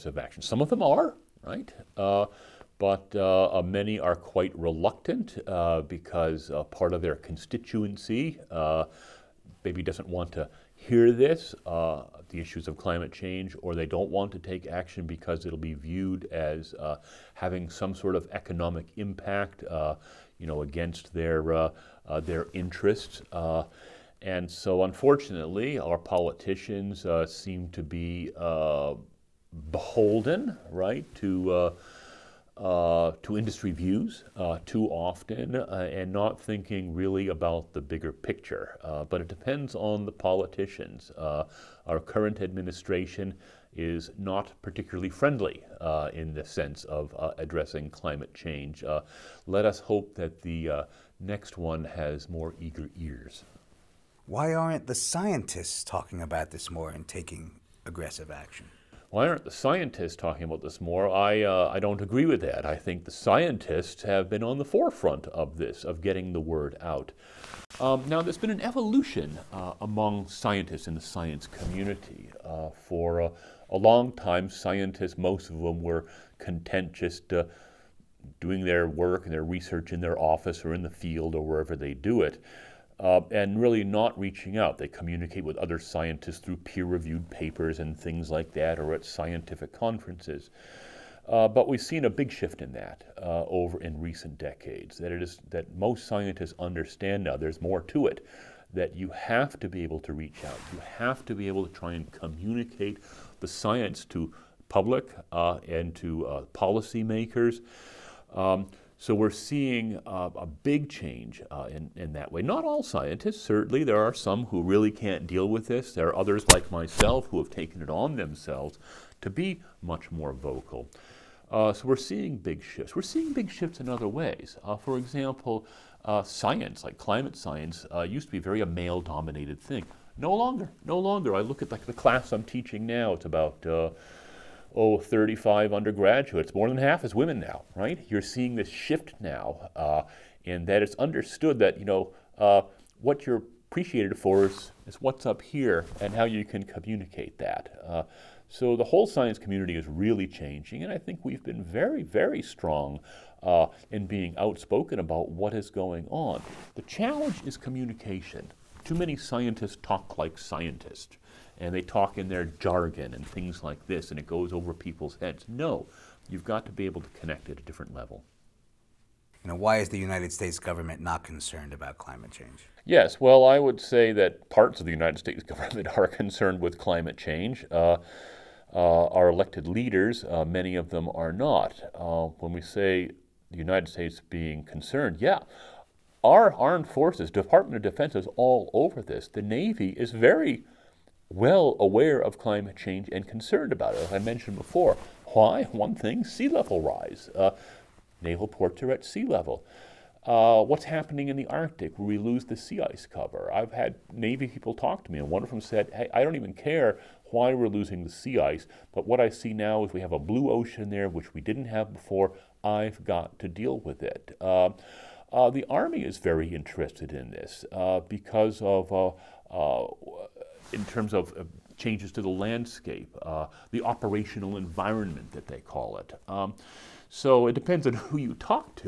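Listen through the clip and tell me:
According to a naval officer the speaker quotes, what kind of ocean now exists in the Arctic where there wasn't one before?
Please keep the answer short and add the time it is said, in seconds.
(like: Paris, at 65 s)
A blue ocean, at 210 s.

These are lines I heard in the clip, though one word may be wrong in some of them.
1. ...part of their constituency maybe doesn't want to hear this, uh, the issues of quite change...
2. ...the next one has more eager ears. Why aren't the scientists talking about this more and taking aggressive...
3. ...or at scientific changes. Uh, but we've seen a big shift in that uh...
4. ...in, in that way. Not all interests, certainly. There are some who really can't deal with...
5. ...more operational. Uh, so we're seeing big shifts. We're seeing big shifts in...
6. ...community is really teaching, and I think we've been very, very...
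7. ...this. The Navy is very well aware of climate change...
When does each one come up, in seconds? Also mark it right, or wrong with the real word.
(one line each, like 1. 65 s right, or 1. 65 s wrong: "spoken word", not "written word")
1. 6 s wrong: "climate", not "quite"
2. 50 s right
3. 88 s wrong: "conferences", not "changes"
4. 111 s wrong: "scientists", not "interests"
5. 120 s wrong: "vocal", not "operational"
6. 149 s wrong: "changing", not "teaching"
7. 189 s right.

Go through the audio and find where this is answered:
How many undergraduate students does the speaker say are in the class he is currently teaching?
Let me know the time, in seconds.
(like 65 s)
134 s.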